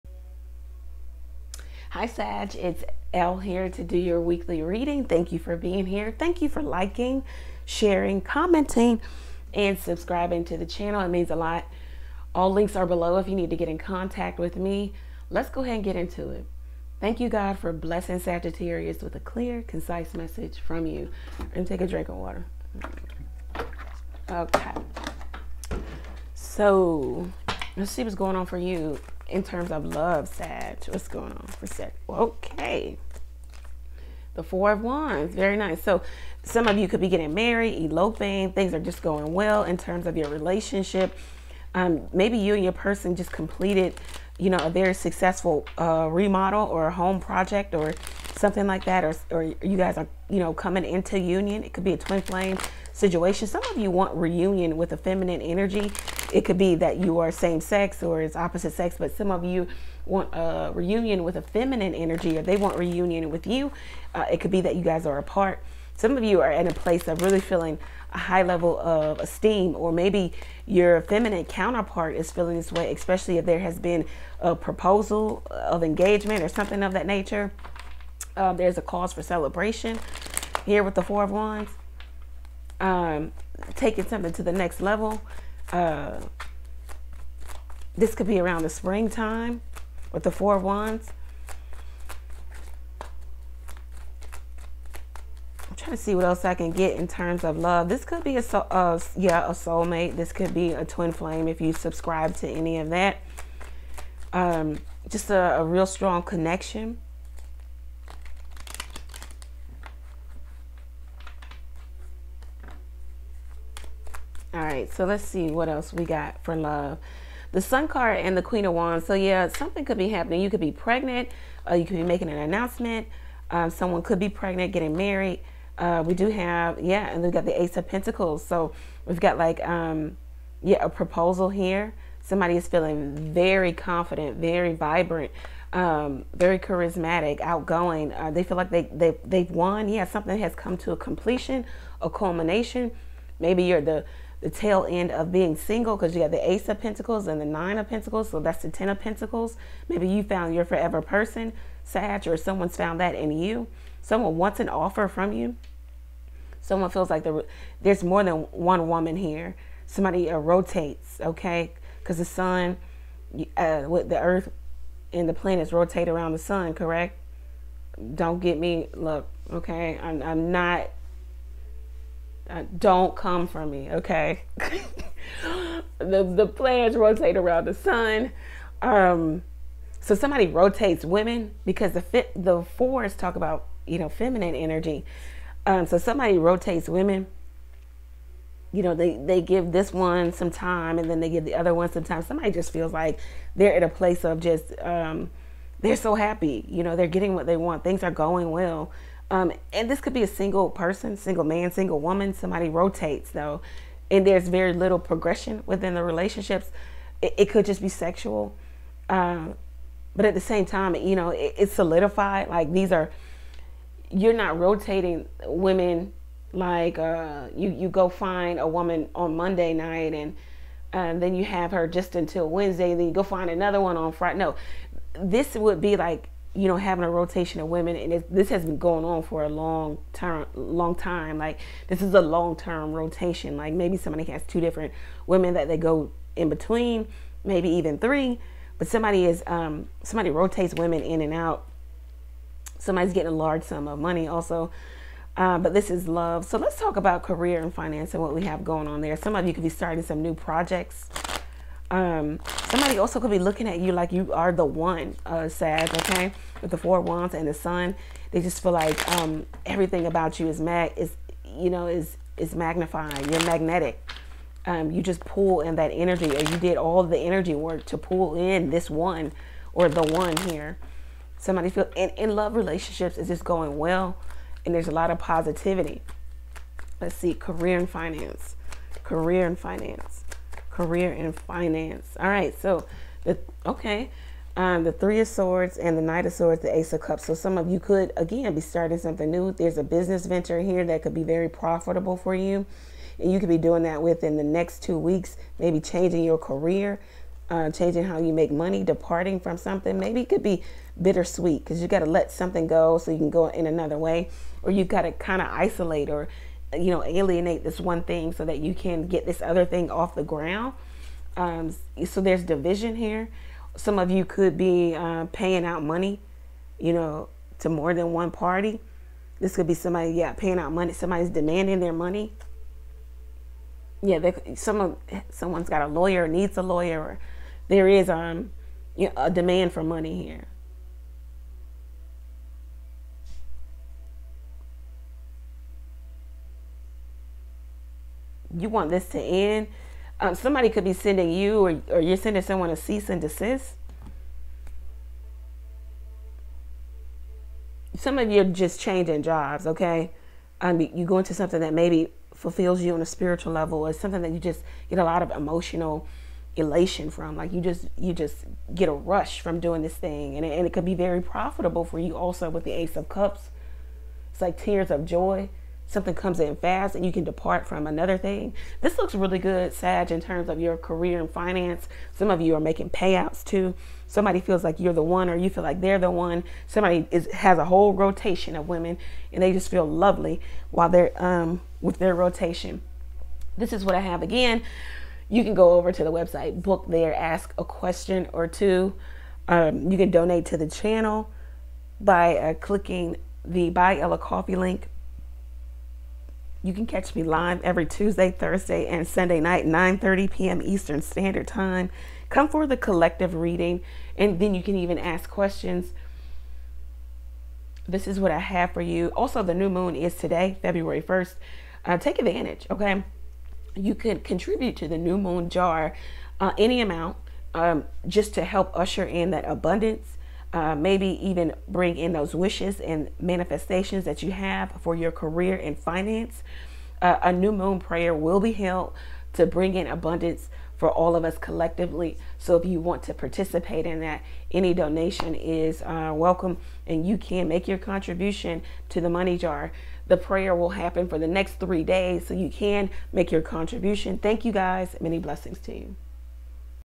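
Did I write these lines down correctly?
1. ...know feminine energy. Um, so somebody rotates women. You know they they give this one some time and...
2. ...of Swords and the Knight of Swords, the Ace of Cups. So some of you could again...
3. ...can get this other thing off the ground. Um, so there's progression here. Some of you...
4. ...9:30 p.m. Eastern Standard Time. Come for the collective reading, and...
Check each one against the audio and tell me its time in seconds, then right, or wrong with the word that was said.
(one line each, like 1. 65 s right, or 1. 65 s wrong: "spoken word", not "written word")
1. 183 s right
2. 285 s right
3. 308 s wrong: "division", not "progression"
4. 399 s right.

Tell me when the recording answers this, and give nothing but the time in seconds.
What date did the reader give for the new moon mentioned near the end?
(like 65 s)
410 s.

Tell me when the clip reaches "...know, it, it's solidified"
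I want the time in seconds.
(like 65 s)
211 s.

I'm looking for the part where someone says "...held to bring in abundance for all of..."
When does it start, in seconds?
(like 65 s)
428 s.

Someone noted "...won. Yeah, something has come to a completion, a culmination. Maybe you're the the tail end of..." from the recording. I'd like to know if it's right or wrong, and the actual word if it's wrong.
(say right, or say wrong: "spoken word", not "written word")
right.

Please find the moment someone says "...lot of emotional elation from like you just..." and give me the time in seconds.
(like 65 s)
355 s.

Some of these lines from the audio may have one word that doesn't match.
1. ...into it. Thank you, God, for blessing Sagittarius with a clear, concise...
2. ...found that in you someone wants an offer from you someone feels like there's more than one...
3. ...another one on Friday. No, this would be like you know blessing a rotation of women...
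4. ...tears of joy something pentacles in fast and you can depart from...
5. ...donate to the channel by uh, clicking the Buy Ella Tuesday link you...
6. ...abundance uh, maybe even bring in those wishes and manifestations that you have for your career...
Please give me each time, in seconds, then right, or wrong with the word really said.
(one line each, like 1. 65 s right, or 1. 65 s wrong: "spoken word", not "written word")
1. 15 s right
2. 152 s right
3. 223 s wrong: "having", not "blessing"
4. 364 s wrong: "comes", not "pentacles"
5. 390 s wrong: "Coffee", not "Tuesday"
6. 419 s right.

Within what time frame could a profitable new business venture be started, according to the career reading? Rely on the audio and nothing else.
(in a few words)
Two weeks.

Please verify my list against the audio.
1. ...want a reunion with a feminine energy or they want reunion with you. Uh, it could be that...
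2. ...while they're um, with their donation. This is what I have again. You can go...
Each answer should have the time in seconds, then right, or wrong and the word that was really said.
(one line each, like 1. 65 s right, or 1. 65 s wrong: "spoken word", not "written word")
1. 60 s right
2. 380 s wrong: "rotation", not "donation".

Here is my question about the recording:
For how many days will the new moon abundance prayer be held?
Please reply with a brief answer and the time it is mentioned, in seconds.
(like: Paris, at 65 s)
3, at 441 s.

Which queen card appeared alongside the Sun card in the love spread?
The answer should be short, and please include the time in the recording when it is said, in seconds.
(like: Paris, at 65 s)
Queen of Wands, at 118 s.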